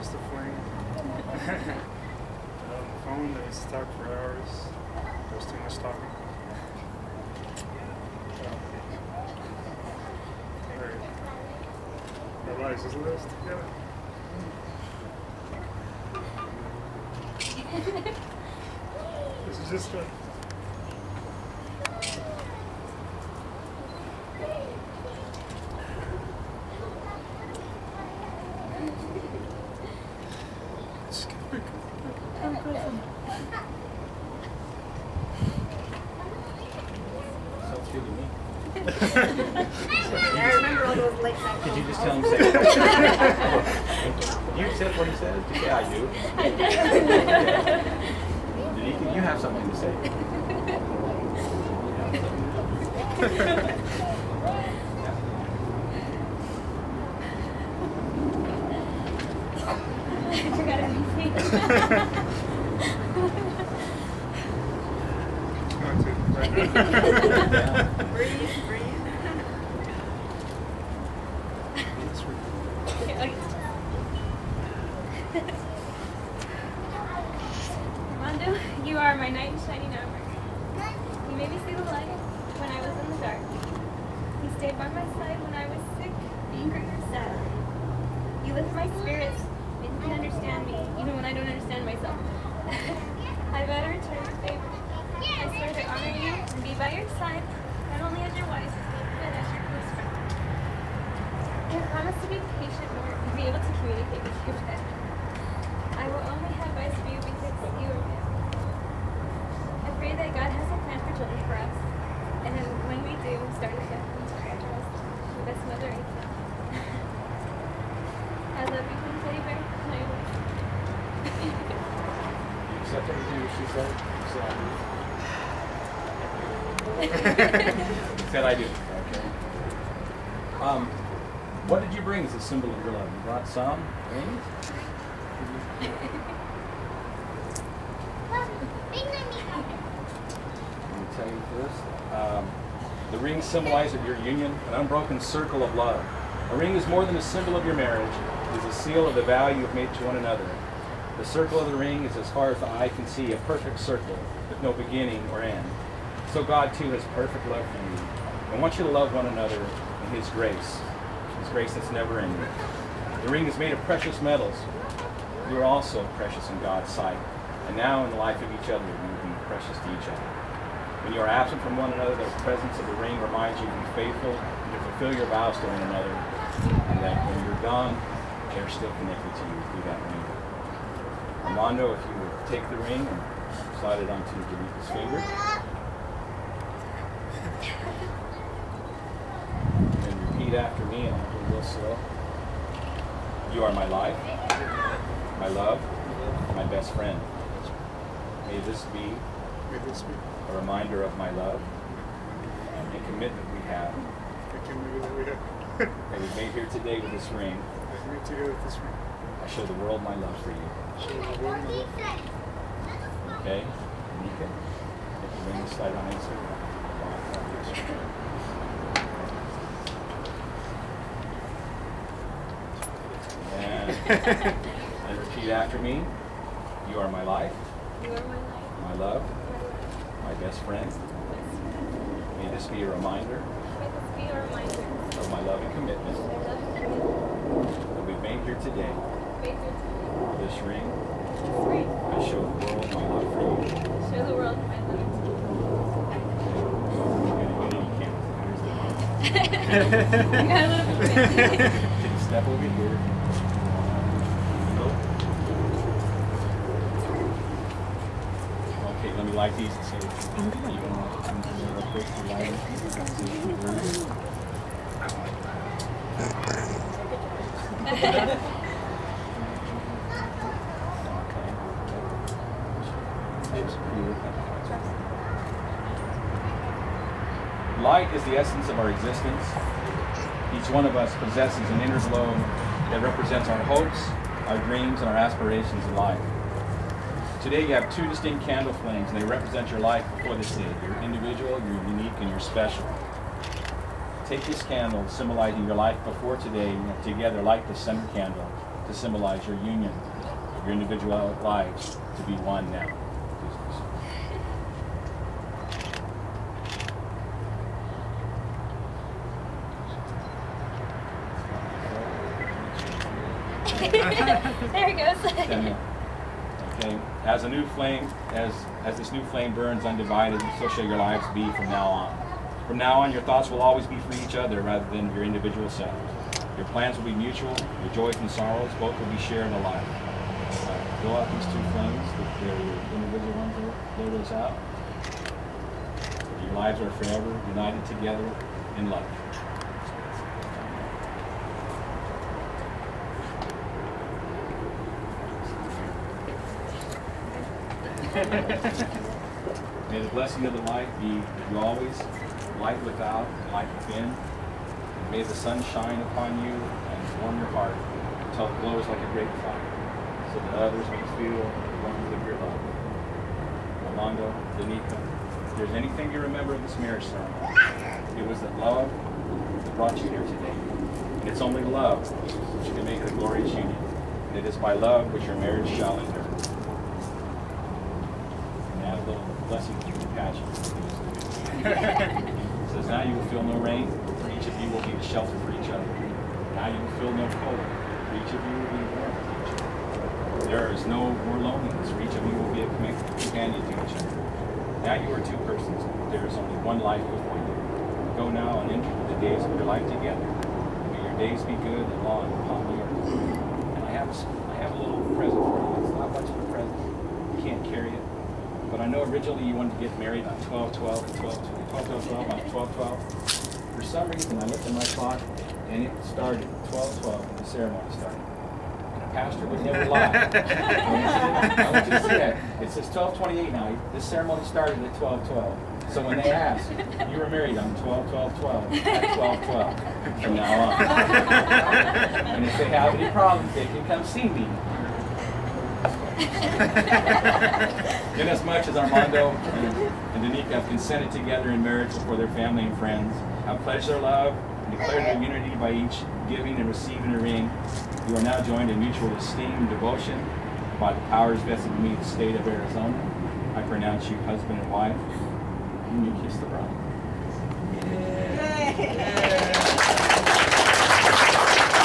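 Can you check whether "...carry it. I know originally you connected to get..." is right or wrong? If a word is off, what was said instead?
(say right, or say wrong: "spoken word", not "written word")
wrong: "wanted", not "connected".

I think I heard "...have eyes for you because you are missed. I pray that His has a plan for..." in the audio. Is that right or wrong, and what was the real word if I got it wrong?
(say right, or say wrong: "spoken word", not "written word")
wrong: "God", not "His".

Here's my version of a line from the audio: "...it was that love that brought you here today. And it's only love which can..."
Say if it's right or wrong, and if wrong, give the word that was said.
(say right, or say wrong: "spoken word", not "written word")
right.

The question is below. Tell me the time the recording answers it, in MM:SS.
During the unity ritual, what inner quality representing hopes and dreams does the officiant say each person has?
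04:41.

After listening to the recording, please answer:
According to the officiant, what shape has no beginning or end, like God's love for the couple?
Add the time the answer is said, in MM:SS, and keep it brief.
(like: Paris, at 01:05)
perfect circle, at 02:33.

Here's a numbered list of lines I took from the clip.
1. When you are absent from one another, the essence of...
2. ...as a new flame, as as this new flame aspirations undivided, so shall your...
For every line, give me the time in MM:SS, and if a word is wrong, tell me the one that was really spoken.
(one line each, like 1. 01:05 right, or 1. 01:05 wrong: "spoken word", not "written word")
1. 02:51 wrong: "presence", not "essence"
2. 05:17 wrong: "burns", not "aspirations".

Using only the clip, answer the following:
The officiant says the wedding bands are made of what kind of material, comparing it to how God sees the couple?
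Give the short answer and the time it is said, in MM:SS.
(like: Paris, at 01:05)
precious metals, at 02:43.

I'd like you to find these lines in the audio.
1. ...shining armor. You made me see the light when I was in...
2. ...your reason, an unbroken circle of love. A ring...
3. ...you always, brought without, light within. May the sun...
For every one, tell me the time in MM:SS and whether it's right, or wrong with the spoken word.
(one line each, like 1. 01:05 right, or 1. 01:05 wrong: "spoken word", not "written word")
1. 01:19 right
2. 02:24 wrong: "union", not "reason"
3. 05:51 wrong: "light", not "brought".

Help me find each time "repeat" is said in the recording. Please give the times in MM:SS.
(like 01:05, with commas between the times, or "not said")
03:10, 03:45.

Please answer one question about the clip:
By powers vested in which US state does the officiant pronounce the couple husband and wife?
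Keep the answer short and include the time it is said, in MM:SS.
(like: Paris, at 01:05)
Arizona, at 07:32.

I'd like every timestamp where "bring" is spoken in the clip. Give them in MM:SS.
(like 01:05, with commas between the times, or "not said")
02:12, 03:35.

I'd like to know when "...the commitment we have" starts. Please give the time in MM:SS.
03:22.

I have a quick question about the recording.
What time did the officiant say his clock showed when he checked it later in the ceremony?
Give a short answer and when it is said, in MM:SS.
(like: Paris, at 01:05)
12:28, at 07:02.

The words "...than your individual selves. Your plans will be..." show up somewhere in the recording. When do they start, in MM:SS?
05:24.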